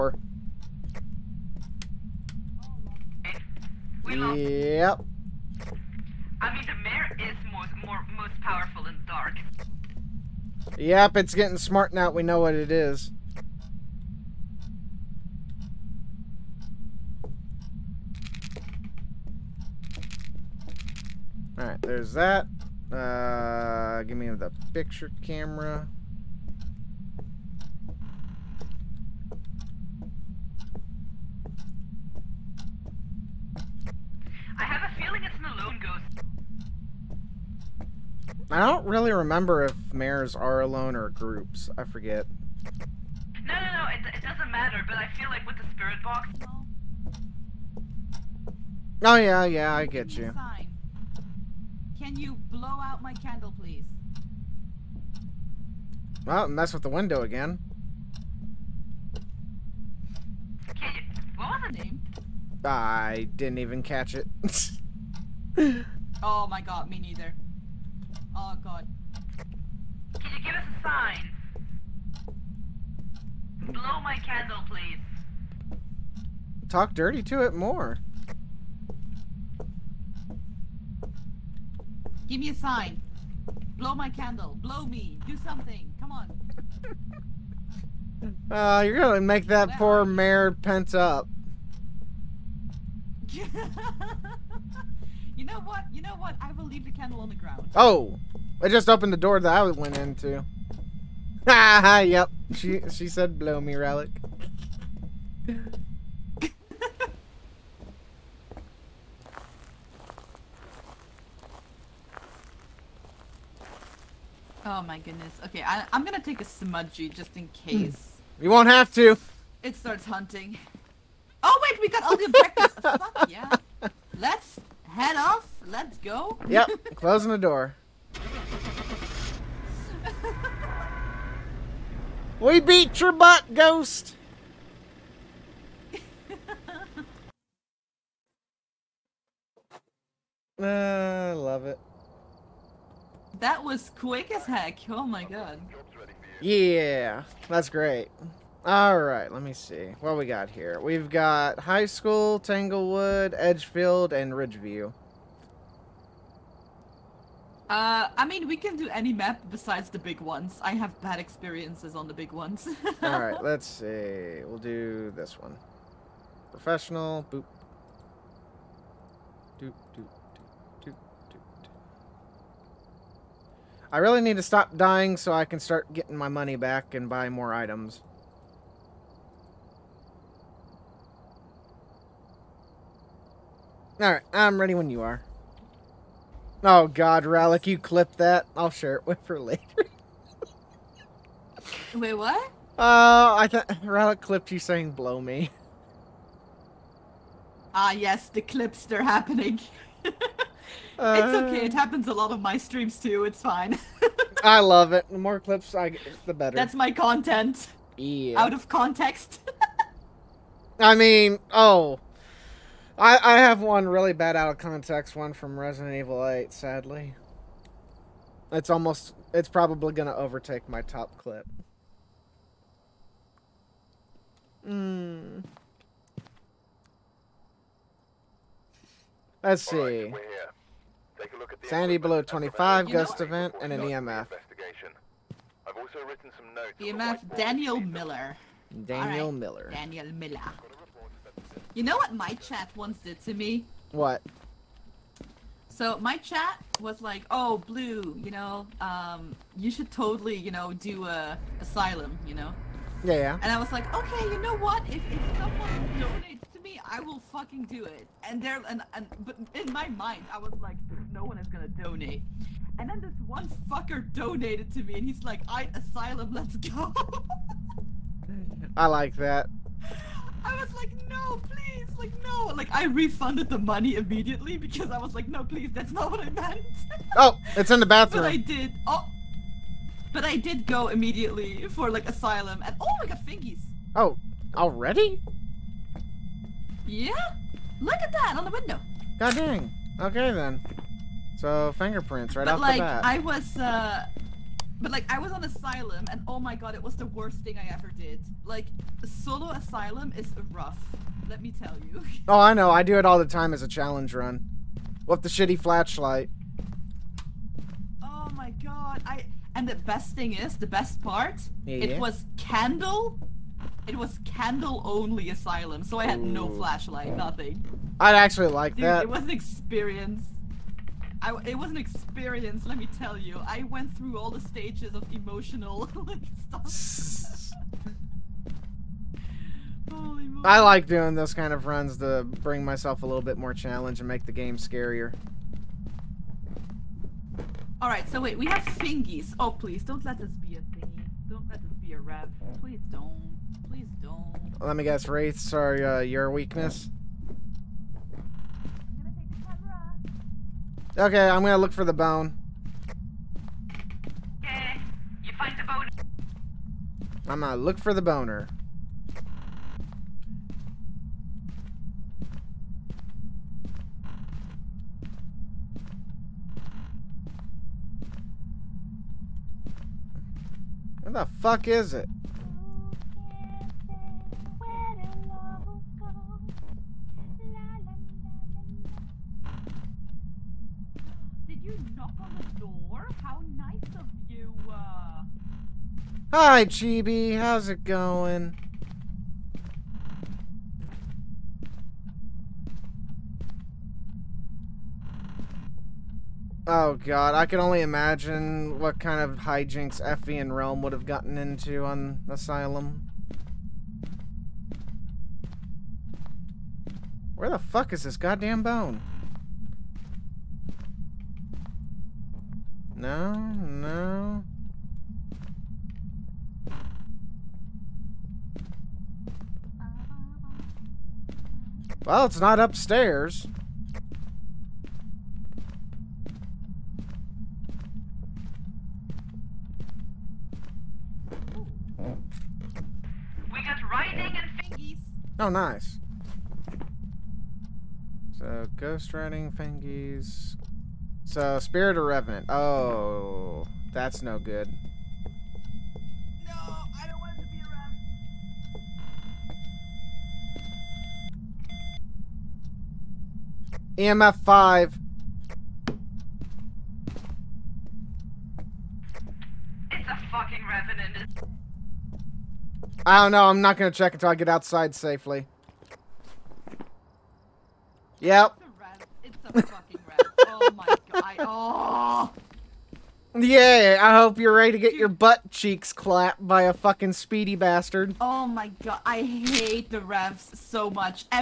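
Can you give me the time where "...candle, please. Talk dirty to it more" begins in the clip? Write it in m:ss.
1:14.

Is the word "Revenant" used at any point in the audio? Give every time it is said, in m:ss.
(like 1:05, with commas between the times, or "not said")
7:22, 7:40.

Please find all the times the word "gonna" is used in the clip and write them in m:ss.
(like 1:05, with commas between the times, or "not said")
1:28, 1:56, 4:21, 5:51, 5:57, 7:43.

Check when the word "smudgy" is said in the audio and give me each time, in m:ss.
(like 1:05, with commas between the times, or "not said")
1:56.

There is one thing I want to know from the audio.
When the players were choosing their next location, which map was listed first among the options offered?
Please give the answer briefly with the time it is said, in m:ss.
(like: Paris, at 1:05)
High School, at 2:31.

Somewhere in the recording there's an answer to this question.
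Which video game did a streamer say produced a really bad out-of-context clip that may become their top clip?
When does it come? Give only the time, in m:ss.
3:35.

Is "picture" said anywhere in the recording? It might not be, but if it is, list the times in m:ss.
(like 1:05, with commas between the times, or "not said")
0:24.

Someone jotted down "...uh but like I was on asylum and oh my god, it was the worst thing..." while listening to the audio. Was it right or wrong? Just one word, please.
right.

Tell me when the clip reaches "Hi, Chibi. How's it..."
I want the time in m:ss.
6:26.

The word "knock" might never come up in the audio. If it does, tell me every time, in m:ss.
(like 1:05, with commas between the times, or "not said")
6:21.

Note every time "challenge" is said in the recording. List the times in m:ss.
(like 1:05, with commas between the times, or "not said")
5:03, 5:33.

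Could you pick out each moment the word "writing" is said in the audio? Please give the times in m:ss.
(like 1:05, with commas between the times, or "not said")
7:13, 7:19.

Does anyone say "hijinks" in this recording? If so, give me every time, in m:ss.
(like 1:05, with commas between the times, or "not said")
6:39.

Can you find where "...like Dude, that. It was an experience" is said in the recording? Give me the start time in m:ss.
5:18.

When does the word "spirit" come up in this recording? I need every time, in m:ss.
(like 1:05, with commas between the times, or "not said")
0:45, 7:21.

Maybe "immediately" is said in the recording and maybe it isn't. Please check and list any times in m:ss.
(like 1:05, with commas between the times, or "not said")
4:33, 4:40.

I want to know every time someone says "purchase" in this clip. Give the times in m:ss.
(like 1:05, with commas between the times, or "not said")
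not said.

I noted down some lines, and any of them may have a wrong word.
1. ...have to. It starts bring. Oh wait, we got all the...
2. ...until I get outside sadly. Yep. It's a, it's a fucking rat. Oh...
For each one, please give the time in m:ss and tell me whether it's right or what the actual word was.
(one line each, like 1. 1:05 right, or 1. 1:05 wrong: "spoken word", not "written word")
1. 1:58 wrong: "hunting", not "bring"
2. 7:44 wrong: "safely", not "sadly".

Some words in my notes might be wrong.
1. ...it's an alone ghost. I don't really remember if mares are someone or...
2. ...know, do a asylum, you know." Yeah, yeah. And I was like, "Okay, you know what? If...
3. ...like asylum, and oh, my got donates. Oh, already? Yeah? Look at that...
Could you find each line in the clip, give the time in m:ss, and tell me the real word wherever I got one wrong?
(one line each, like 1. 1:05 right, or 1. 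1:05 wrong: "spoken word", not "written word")
1. 0:35 wrong: "alone", not "someone"
2. 4:10 right
3. 4:41 wrong: "fingies", not "donates".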